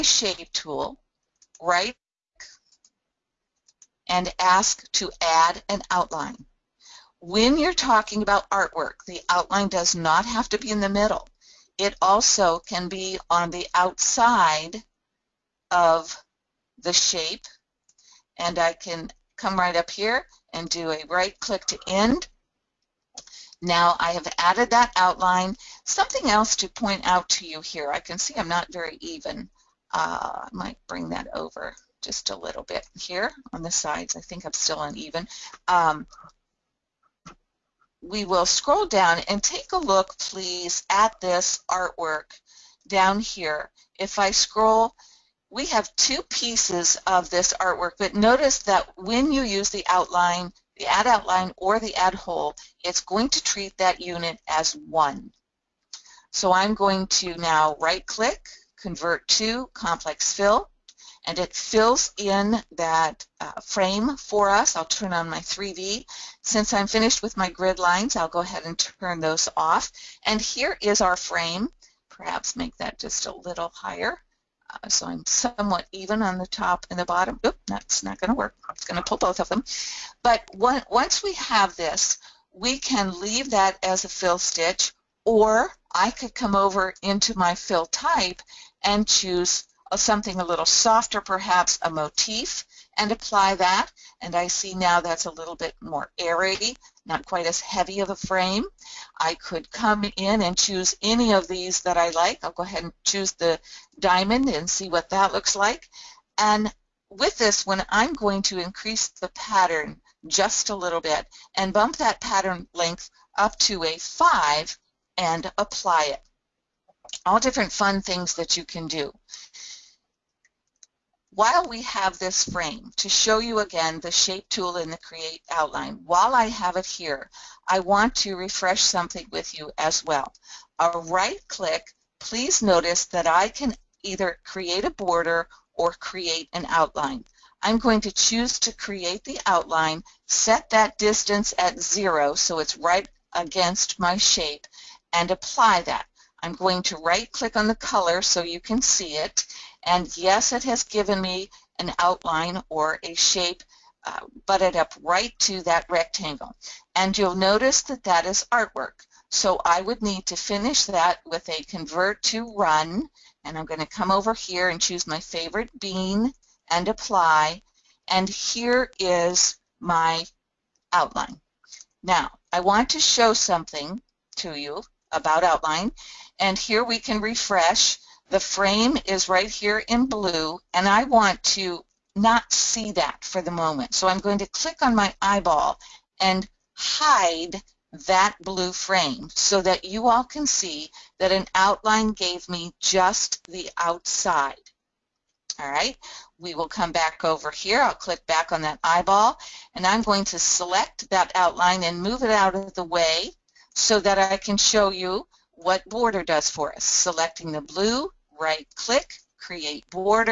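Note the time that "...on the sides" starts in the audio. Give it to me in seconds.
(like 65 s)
33 s.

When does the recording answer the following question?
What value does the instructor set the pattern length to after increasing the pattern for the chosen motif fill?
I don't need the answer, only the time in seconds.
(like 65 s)
113 s.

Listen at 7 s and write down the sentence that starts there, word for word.
When you're talking about artwork, the outline does not have to be in the middle.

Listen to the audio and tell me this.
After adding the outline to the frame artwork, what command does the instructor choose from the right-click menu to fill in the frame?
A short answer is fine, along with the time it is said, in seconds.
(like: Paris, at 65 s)
Convert to complex fill, at 58 s.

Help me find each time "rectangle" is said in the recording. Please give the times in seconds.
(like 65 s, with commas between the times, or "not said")
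155 s.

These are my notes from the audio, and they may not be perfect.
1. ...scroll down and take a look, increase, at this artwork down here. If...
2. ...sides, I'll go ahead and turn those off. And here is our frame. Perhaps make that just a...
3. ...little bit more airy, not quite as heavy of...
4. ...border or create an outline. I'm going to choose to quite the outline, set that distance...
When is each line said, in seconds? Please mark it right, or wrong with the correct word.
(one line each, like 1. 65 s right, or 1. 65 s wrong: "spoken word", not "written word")
1. 38 s wrong: "please", not "increase"
2. 67 s wrong: "lines", not "sides"
3. 95 s right
4. 134 s wrong: "create", not "quite".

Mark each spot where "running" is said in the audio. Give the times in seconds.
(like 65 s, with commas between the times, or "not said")
not said.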